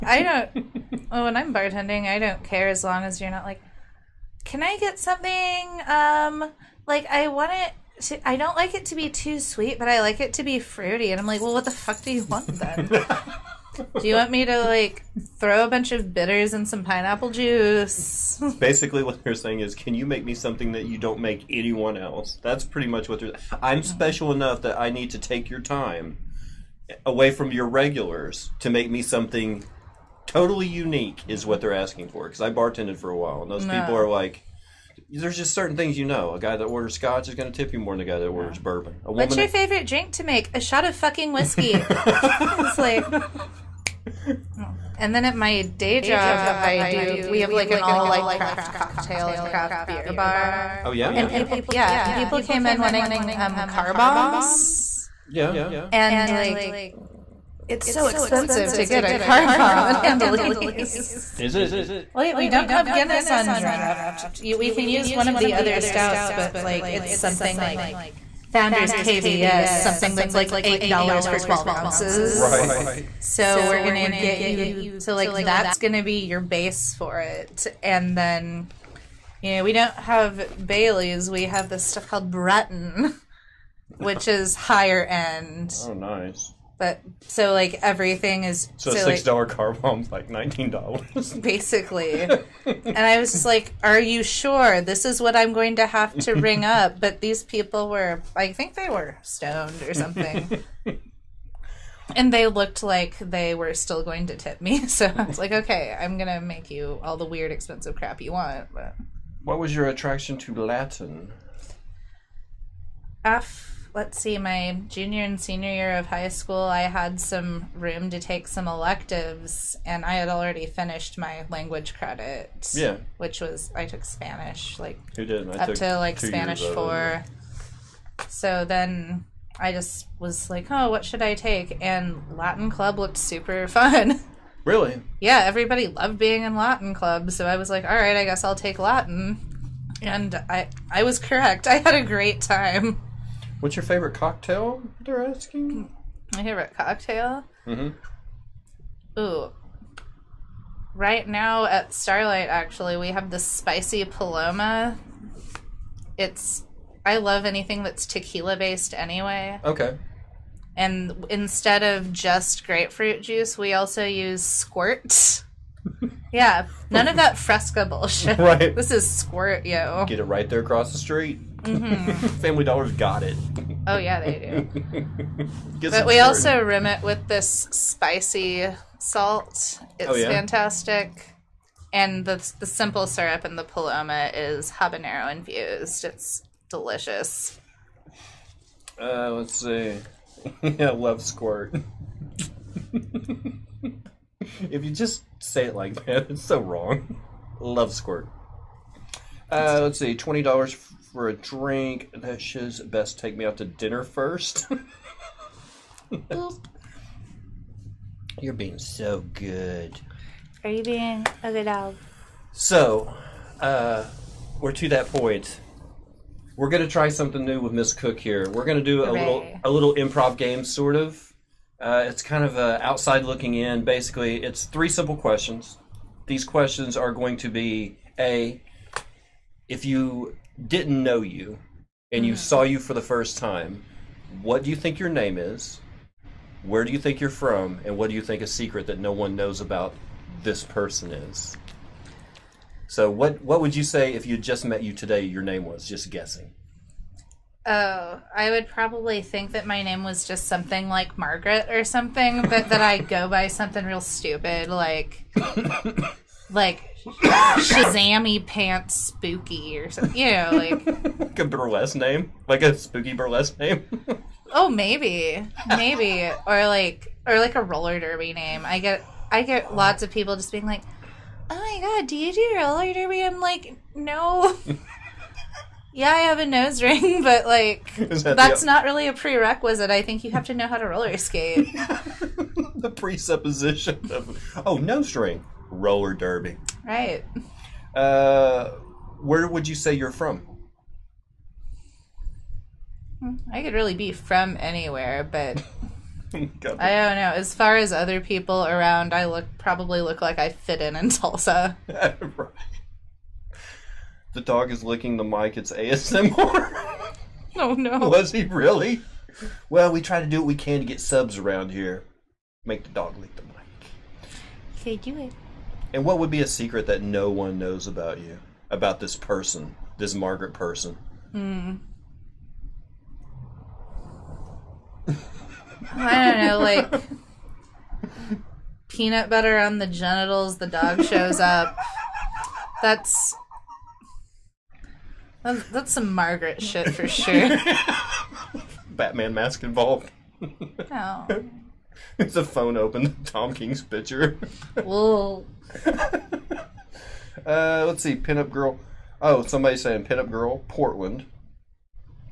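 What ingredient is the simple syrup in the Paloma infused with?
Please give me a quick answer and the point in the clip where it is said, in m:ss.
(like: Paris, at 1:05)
habanero, at 3:04.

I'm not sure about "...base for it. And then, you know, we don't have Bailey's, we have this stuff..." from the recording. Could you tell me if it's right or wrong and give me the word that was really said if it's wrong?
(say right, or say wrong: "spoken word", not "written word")
right.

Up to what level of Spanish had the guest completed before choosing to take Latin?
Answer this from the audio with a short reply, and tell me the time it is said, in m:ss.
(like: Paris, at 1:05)
Spanish 4, at 2:06.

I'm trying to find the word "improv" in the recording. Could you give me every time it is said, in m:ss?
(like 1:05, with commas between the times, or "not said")
3:39.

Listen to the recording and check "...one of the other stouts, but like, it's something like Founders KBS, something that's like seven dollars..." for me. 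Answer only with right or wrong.
wrong.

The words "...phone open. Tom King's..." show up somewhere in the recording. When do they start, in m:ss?
5:42.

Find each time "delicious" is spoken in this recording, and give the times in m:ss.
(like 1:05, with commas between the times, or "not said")
3:06.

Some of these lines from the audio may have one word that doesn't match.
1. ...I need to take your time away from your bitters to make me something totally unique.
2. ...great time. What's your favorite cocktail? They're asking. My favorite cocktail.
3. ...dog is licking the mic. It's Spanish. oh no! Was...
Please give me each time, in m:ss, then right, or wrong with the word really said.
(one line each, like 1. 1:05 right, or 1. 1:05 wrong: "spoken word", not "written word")
1. 0:24 wrong: "regulars", not "bitters"
2. 2:22 right
3. 5:04 wrong: "ASMR", not "Spanish".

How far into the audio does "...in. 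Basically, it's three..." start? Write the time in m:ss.
3:43.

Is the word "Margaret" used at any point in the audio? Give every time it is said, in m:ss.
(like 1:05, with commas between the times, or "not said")
4:11, 5:20, 5:36.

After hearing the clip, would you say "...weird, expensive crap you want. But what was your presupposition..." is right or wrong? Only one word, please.
wrong.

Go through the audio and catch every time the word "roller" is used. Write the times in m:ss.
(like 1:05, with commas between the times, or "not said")
4:27, 4:32, 4:40, 4:45.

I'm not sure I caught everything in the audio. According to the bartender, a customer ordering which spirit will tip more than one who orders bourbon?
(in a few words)
scotch.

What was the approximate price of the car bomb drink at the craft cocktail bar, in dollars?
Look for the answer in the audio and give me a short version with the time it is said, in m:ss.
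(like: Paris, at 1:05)
19, at 1:30.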